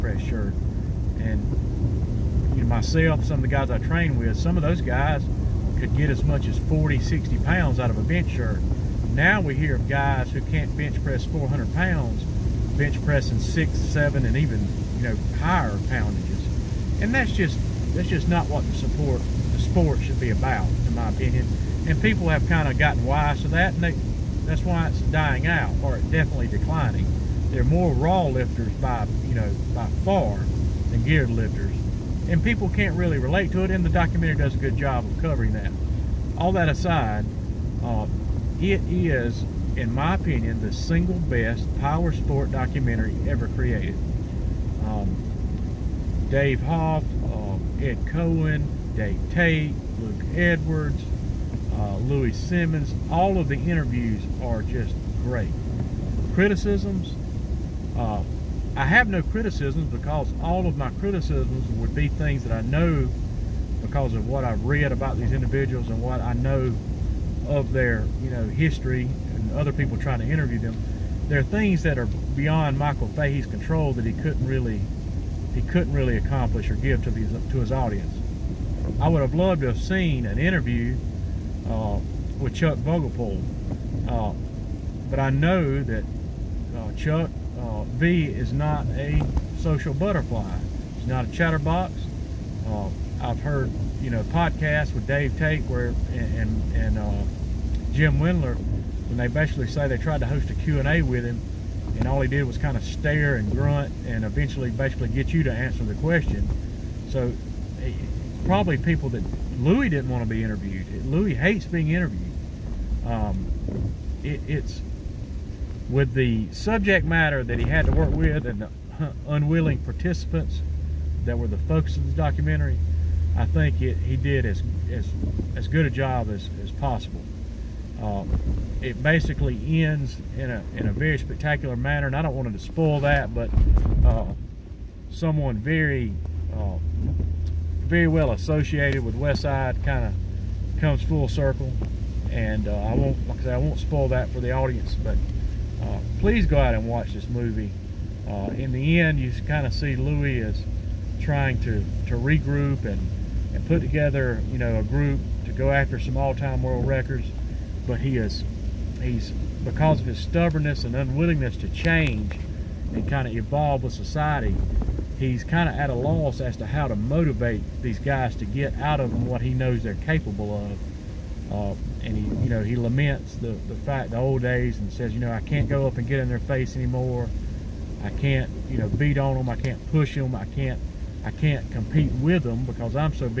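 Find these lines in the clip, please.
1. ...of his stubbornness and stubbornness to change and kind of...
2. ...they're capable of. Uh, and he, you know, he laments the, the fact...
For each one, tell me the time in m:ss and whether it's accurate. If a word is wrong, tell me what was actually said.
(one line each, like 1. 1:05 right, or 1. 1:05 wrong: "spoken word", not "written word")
1. 2:40 wrong: "unwillingness", not "stubbornness"
2. 2:49 right.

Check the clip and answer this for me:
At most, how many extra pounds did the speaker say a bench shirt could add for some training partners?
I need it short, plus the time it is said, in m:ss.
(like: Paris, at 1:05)
60 pounds, at 0:07.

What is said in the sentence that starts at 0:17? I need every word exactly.
And that's just that's just not what the support the sport should be about, in my opinion.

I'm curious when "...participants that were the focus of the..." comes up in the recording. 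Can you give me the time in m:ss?
1:59.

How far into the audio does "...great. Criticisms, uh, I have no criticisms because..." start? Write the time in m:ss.
0:55.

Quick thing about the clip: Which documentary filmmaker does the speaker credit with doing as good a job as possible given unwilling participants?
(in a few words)
Michael Fahey.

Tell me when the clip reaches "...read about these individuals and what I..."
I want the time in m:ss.
1:04.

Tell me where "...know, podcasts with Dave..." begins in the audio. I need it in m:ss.
1:34.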